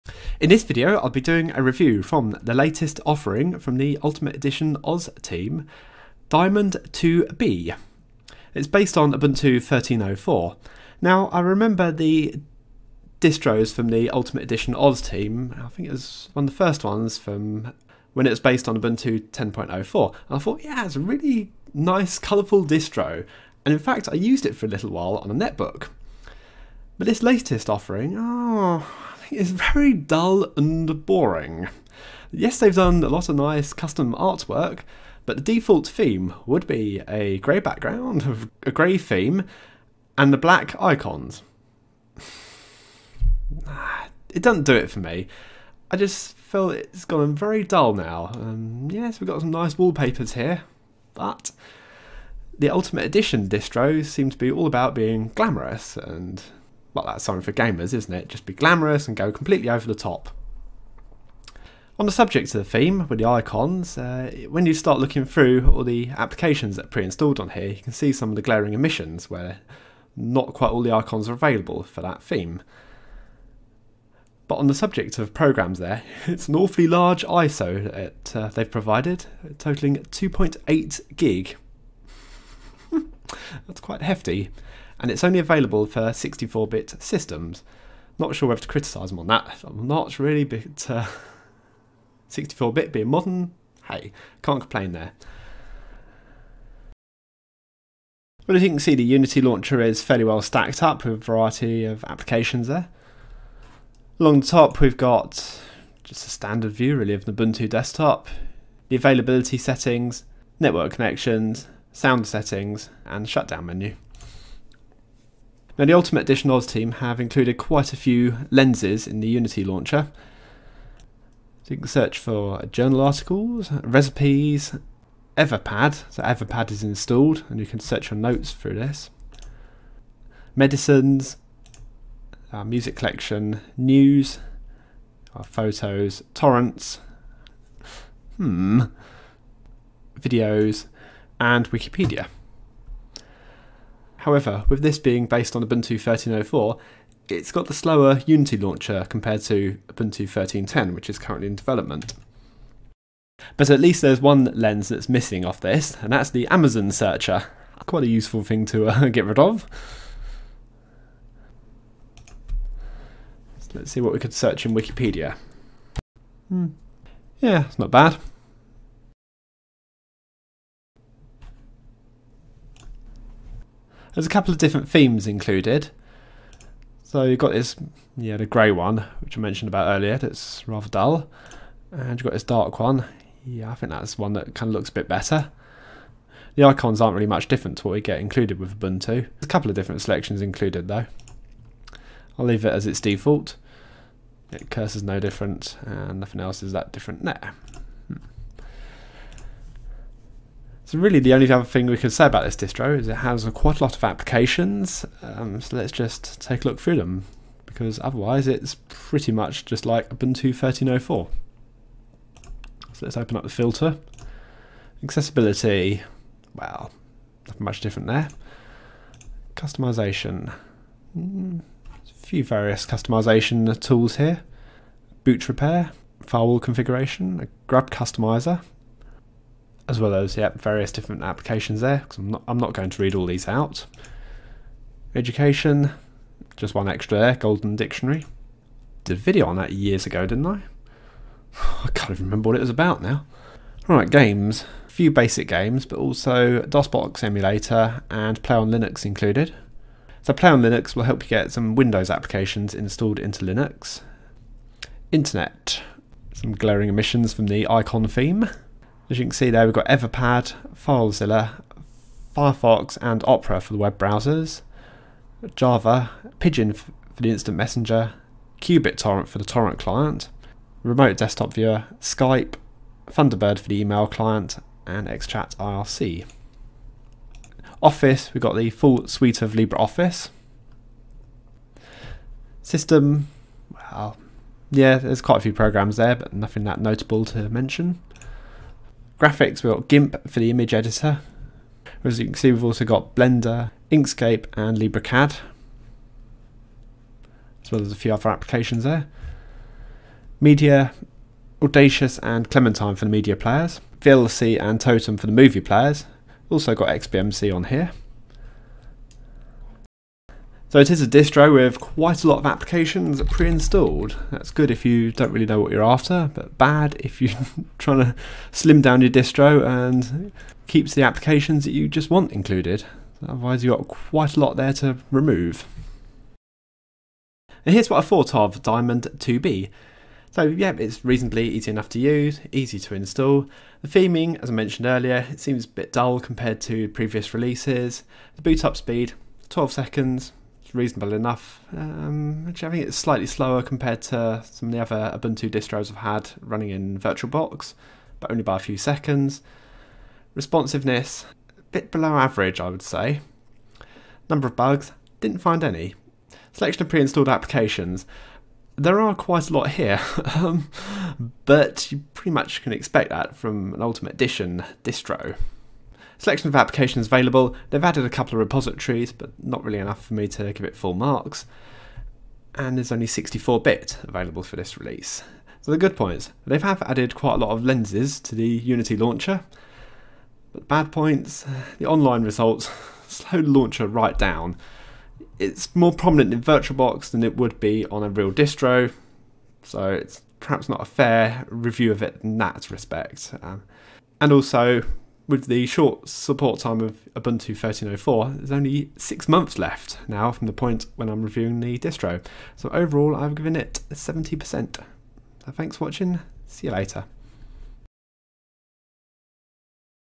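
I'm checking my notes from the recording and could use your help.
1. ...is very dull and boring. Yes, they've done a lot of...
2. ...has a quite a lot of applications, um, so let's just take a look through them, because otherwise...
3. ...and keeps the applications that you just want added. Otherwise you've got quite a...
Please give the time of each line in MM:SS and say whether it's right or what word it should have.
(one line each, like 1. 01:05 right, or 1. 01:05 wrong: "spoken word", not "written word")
1. 00:29 right
2. 03:23 right
3. 05:19 wrong: "included", not "added".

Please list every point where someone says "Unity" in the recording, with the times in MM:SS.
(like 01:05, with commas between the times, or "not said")
01:39, 01:59, 02:28, 06:18.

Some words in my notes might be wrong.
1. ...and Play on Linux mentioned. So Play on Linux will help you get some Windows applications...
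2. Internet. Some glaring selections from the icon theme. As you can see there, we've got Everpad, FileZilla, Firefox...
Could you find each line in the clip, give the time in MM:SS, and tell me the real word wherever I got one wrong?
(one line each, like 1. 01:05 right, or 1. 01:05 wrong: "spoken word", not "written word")
1. 04:08 wrong: "included", not "mentioned"
2. 04:15 wrong: "emissions", not "selections".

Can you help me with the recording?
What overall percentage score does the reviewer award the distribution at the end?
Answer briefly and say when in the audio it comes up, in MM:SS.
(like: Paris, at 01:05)
70%, at 06:43.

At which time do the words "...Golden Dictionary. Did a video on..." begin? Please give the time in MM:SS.
03:57.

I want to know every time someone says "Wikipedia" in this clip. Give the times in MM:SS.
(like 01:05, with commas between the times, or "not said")
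02:21, 02:44.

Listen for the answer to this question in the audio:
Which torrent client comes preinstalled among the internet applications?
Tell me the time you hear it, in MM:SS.
04:28.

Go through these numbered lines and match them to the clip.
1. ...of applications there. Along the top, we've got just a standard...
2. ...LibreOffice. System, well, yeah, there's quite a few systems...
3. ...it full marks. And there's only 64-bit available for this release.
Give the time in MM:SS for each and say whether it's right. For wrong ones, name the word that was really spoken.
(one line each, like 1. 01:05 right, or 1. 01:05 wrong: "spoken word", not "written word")
1. 01:41 right
2. 04:39 wrong: "programs", not "systems"
3. 06:10 right.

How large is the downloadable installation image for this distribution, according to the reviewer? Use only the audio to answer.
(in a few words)
2.8 gig.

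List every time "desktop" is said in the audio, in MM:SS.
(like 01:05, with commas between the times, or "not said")
01:47, 04:31.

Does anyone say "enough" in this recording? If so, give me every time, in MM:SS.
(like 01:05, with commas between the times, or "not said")
05:31, 05:41, 06:09.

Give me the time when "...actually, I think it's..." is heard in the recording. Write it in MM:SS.
05:42.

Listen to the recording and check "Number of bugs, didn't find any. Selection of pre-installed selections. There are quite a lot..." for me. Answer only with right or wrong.
wrong.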